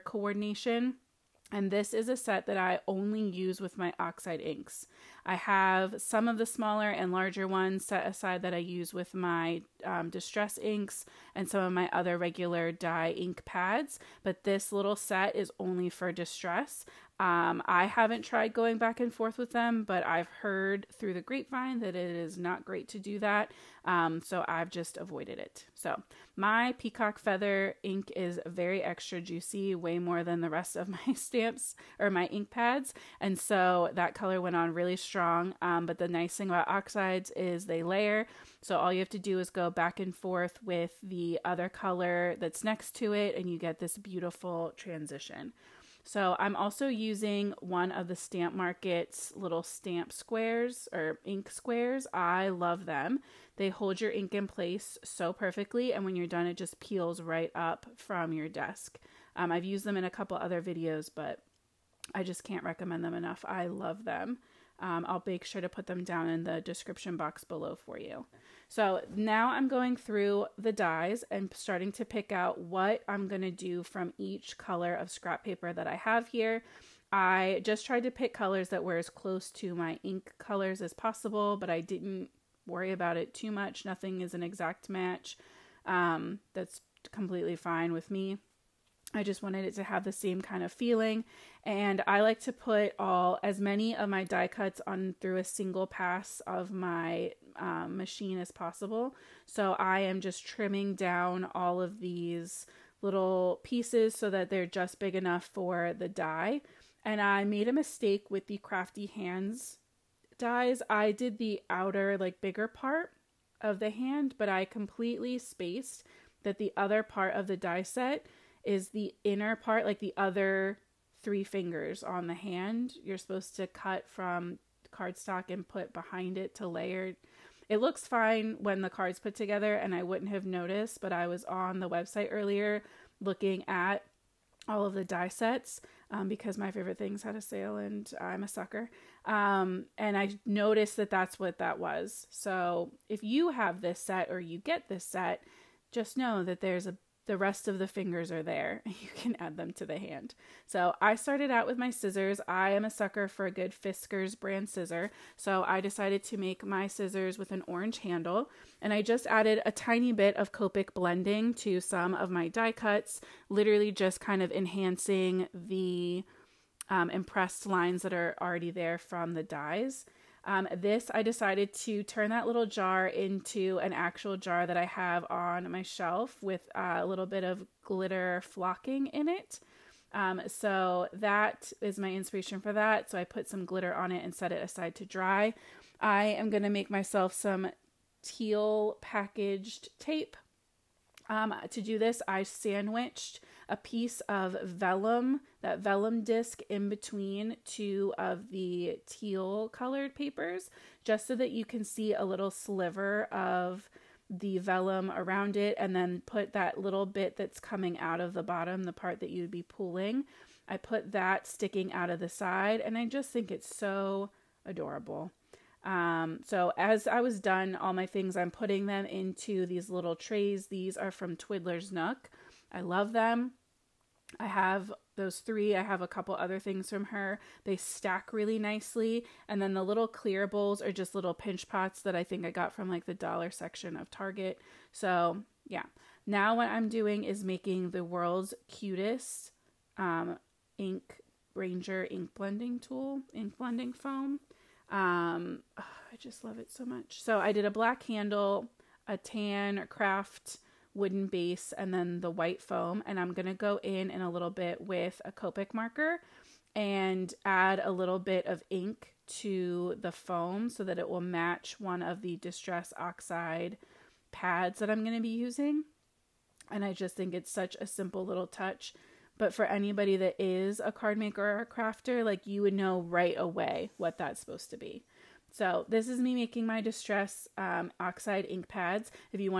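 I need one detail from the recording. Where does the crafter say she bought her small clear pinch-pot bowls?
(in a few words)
Target.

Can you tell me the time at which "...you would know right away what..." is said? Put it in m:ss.
4:32.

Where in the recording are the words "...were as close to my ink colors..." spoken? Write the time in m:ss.
1:18.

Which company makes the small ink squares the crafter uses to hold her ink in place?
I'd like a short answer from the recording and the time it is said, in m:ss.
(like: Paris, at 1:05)
Stamp Market, at 0:48.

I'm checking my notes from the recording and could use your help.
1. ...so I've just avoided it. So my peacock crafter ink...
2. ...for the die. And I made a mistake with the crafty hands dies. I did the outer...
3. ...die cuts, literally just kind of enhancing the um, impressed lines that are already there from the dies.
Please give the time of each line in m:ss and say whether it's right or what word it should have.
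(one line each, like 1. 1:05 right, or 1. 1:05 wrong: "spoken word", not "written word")
1. 0:24 wrong: "feather", not "crafter"
2. 1:45 right
3. 2:42 right.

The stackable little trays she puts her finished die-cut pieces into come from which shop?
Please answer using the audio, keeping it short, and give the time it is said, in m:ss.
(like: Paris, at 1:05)
Twiddler's Nook, at 3:41.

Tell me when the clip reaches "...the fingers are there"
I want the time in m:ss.
2:27.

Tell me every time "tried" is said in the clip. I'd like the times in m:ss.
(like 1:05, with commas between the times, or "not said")
0:18, 1:17.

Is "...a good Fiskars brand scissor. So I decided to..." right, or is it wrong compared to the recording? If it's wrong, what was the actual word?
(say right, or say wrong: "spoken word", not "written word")
right.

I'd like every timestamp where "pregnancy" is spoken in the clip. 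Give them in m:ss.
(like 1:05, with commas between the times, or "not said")
not said.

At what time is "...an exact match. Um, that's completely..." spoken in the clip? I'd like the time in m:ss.
1:24.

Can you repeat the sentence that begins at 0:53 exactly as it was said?
They hold your ink in place so perfectly, and when you're done, it just peels right up from your desk.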